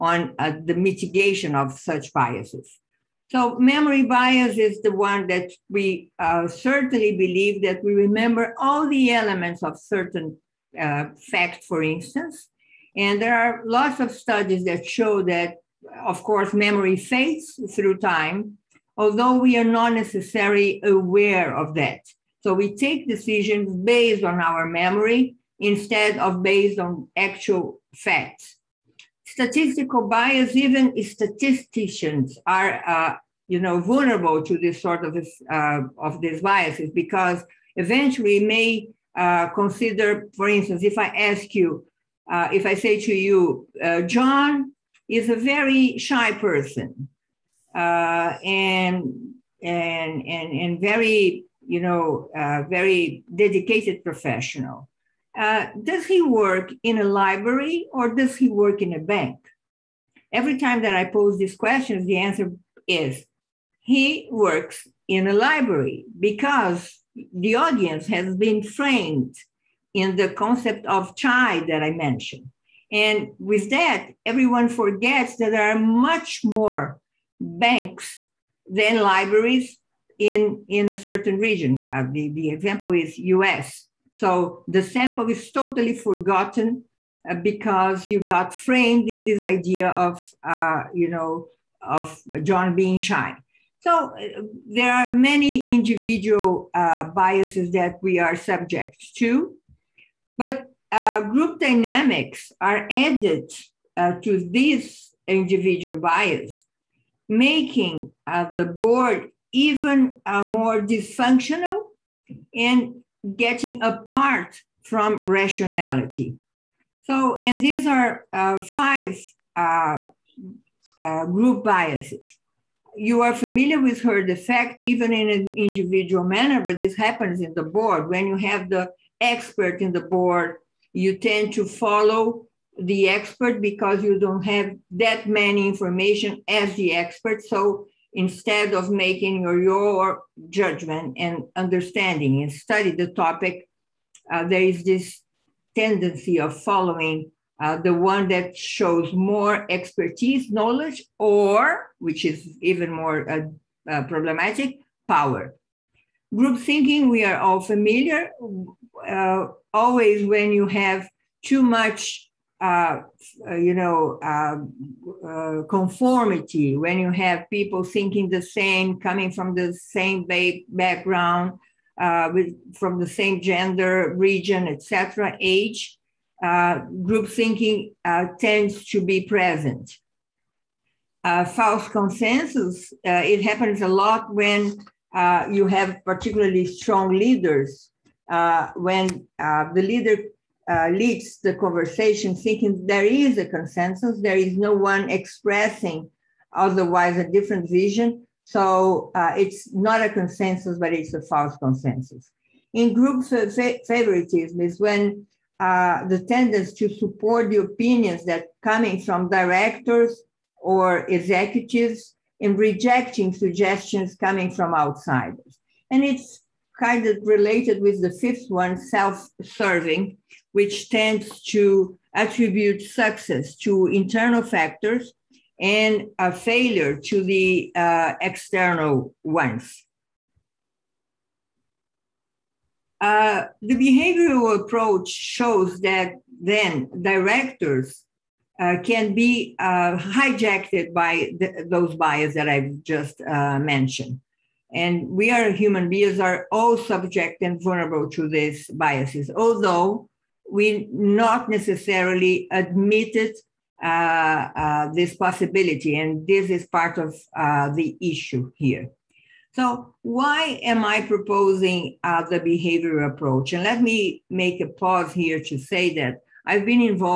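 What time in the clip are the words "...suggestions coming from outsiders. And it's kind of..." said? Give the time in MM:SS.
03:33.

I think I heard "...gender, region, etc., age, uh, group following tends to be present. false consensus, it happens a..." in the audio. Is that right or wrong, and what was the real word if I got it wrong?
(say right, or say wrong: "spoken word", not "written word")
wrong: "thinking", not "following".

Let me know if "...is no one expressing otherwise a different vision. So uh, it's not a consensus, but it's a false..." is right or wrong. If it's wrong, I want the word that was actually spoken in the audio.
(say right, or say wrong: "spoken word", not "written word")
right.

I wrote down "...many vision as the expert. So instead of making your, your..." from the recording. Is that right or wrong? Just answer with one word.
wrong.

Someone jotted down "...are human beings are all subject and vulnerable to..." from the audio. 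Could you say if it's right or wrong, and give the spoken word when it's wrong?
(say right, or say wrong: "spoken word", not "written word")
right.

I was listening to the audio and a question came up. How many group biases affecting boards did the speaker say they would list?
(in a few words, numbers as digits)
5.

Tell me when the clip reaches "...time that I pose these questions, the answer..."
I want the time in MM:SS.
01:00.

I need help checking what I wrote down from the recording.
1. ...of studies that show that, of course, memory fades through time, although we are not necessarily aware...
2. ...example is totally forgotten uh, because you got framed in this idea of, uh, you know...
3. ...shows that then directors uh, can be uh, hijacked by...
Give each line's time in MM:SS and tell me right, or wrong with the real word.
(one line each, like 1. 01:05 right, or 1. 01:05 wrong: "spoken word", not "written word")
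1. 00:14 right
2. 01:24 wrong: "sample", not "example"
3. 03:55 right.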